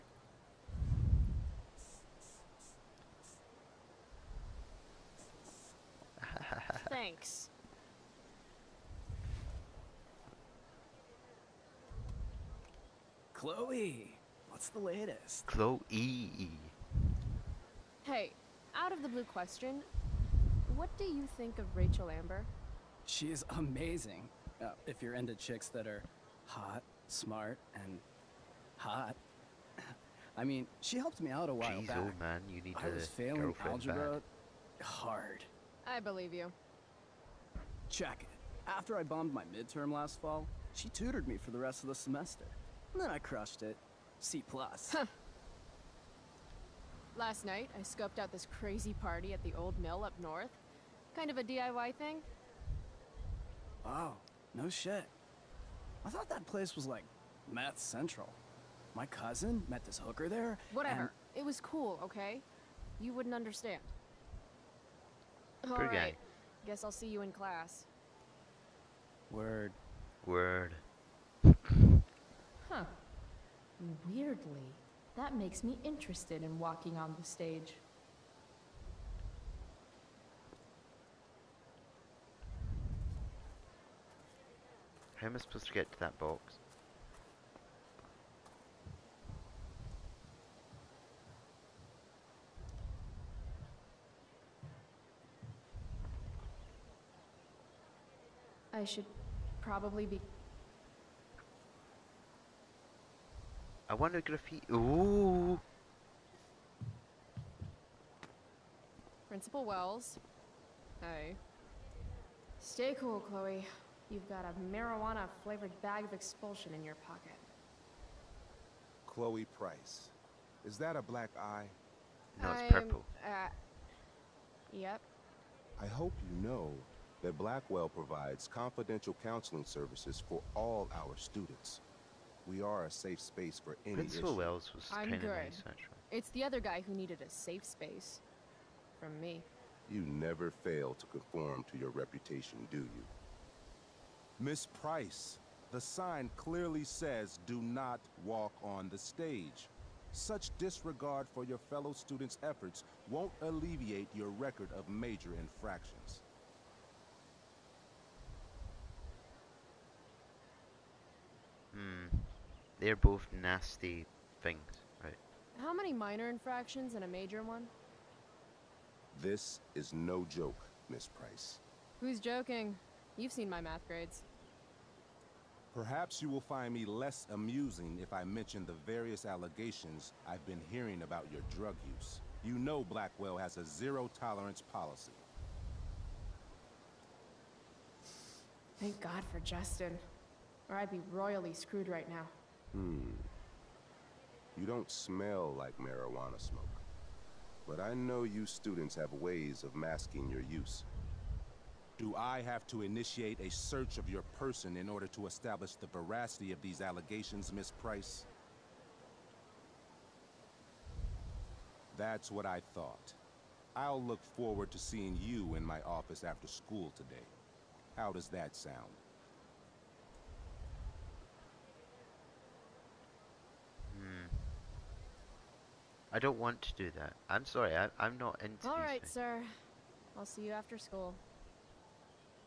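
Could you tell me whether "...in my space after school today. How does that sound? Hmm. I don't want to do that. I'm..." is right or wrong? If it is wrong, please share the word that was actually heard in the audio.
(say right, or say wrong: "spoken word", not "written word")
wrong: "office", not "space".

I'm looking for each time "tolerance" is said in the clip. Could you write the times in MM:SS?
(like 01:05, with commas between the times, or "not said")
03:03.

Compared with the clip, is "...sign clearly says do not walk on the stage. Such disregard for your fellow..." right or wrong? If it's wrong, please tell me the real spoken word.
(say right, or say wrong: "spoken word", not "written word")
right.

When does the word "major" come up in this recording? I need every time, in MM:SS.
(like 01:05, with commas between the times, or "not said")
02:34, 02:47.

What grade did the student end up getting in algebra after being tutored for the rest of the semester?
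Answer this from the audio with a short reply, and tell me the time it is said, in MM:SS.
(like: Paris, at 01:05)
C+, at 00:44.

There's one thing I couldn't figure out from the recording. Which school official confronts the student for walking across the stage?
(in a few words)
Principal Wells.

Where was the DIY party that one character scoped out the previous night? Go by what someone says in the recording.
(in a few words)
the old mill.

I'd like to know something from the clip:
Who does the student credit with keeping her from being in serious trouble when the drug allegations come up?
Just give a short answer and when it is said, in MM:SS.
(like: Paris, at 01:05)
Justin, at 03:09.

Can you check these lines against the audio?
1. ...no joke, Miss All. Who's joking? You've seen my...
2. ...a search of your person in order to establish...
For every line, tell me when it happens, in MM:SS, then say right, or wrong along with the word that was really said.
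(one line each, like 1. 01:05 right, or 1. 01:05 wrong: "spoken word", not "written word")
1. 02:49 wrong: "Price", not "All"
2. 03:23 right.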